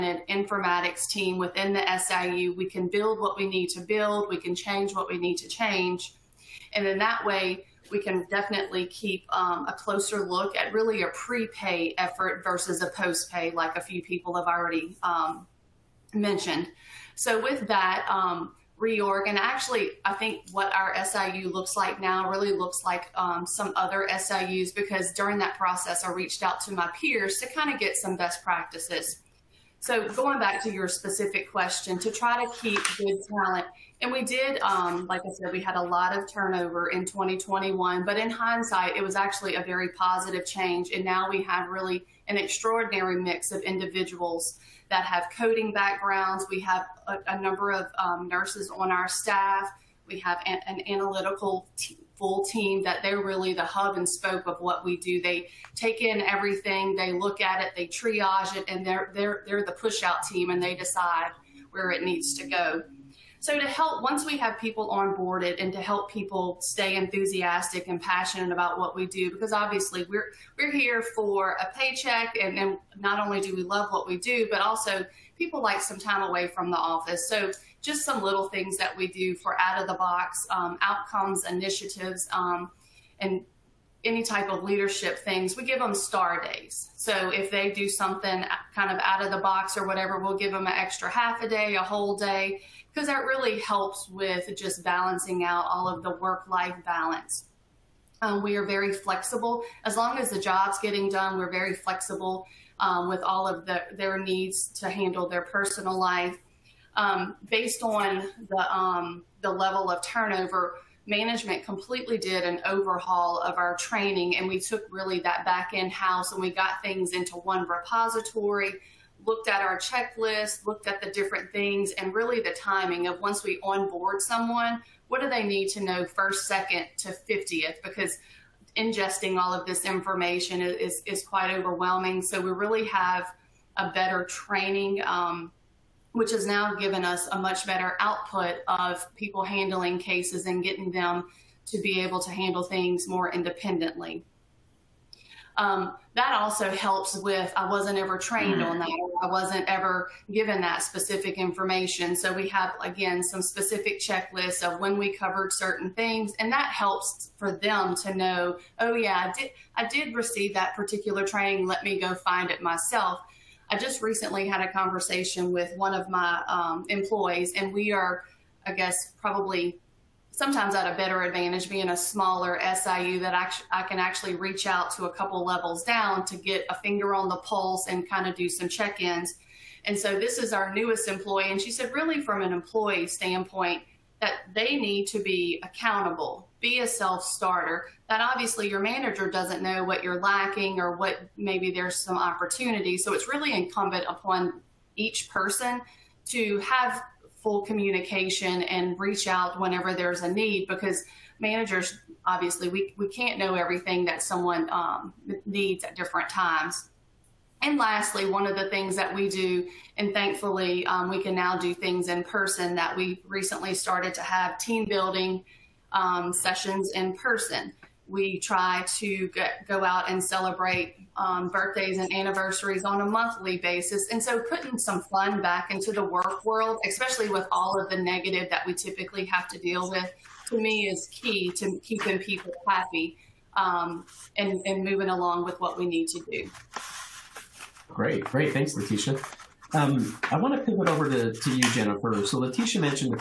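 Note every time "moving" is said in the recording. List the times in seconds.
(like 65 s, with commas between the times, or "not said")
234 s.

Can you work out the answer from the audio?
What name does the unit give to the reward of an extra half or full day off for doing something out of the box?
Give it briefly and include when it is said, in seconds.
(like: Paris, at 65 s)
star days, at 85 s.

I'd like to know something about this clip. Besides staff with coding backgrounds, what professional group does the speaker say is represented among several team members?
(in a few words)
nurses.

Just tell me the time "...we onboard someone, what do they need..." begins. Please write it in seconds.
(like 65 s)
123 s.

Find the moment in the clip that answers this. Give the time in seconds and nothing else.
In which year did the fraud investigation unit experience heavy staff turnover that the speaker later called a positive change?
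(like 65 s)
37 s.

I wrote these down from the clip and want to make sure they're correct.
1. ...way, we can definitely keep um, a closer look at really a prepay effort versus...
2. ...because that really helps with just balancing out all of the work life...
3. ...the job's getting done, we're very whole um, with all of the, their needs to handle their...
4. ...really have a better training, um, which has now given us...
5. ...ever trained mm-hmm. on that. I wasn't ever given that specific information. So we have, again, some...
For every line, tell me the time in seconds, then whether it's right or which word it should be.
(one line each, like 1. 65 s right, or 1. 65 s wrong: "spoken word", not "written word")
1. 7 s right
2. 92 s right
3. 100 s wrong: "flexible", not "whole"
4. 132 s right
5. 147 s right.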